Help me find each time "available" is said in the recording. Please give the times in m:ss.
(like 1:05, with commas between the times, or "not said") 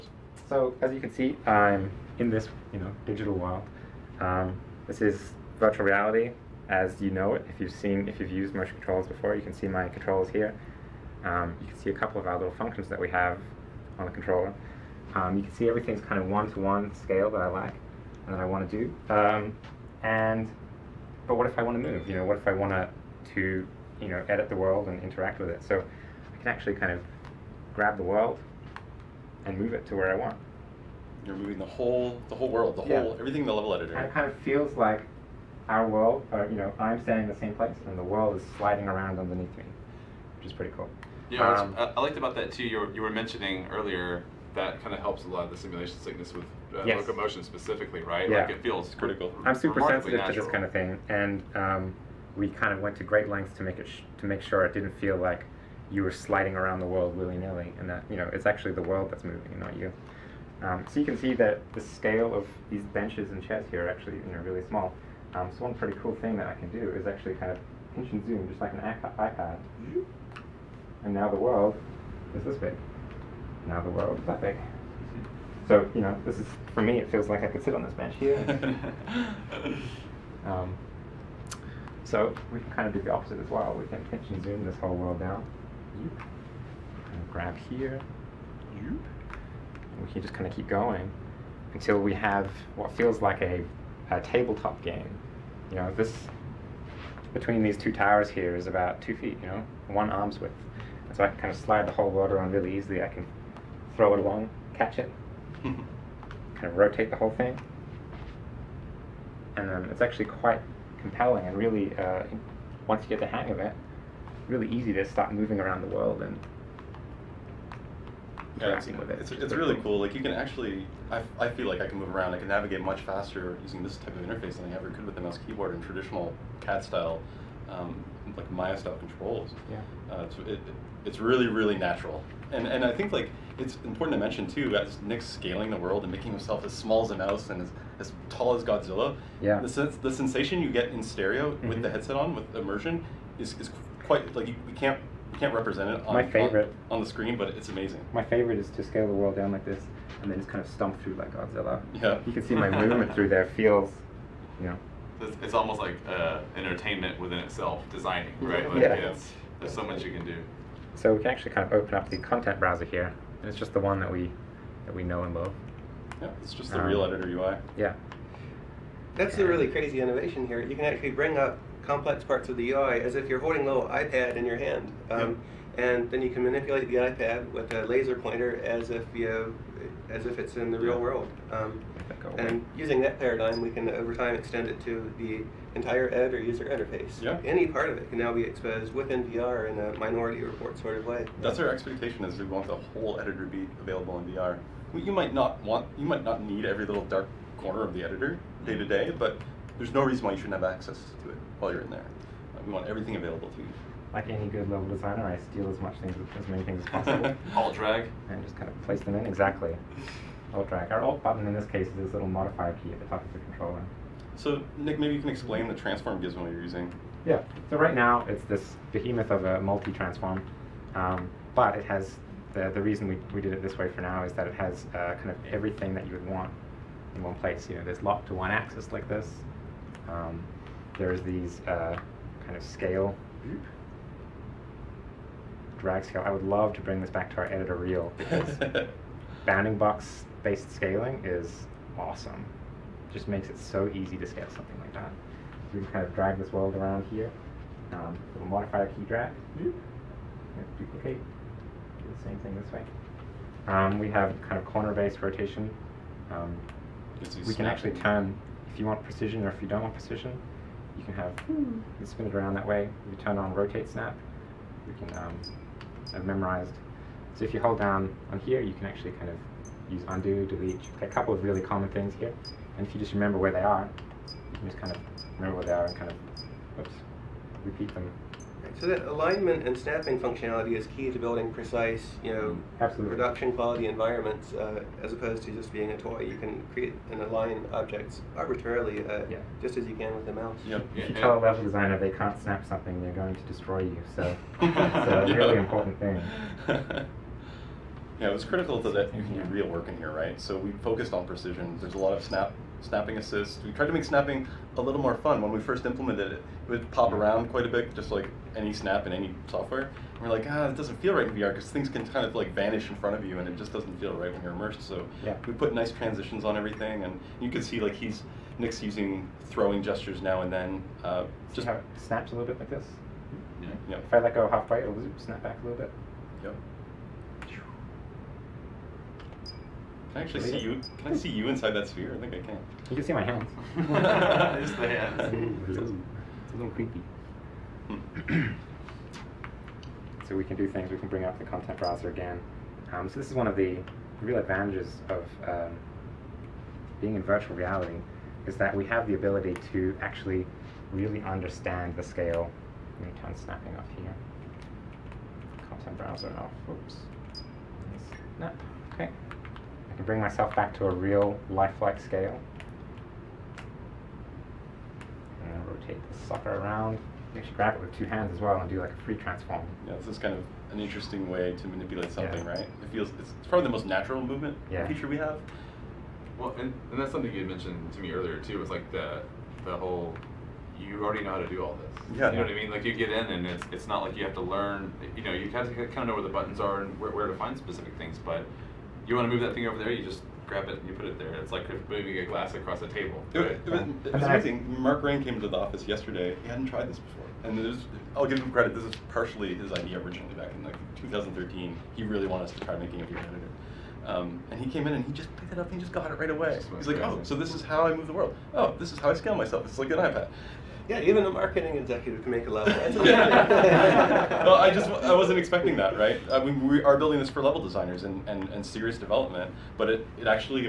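3:13, 3:23.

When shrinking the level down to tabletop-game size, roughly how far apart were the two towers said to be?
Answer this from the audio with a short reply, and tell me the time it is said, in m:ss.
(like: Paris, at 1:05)
2 feet, at 1:39.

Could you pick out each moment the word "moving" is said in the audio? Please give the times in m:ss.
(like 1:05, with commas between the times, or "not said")
0:31, 0:59, 1:55, 6:31.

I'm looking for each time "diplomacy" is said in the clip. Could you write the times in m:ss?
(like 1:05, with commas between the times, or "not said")
not said.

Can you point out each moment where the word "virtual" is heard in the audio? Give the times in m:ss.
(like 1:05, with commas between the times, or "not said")
0:05, 5:47.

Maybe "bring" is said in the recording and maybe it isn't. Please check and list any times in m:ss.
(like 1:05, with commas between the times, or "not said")
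2:51, 3:56, 5:41, 6:00.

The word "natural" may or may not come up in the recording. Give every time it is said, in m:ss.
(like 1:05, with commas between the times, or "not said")
0:50, 2:11, 6:13.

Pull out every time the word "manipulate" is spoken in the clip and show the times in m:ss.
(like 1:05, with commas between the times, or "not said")
2:56, 6:11.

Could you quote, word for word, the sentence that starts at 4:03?
Just makes it so easy to scale something like that.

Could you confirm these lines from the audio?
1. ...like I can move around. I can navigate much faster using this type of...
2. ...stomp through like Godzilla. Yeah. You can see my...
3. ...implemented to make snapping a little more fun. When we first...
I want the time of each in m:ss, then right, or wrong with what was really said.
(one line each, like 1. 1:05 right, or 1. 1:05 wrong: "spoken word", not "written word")
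1. 2:01 right
2. 2:30 right
3. 5:03 wrong: "tried", not "implemented".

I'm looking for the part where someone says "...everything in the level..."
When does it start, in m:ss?
0:33.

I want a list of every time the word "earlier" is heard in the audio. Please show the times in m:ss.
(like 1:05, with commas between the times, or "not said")
0:43, 6:18.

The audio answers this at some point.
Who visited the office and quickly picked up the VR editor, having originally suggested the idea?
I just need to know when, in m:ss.
6:34.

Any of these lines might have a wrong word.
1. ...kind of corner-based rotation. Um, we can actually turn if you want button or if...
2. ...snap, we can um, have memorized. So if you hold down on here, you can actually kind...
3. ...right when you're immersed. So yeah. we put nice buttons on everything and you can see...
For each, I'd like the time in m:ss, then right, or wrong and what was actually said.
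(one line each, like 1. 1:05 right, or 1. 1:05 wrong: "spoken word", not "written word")
1. 4:14 wrong: "precision", not "button"
2. 4:23 right
3. 5:14 wrong: "transitions", not "buttons".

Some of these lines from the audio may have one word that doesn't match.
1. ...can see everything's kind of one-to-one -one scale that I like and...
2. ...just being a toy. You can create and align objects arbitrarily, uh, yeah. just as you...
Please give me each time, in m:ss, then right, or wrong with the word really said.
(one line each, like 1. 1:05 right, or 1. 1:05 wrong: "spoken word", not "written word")
1. 0:15 right
2. 4:45 right.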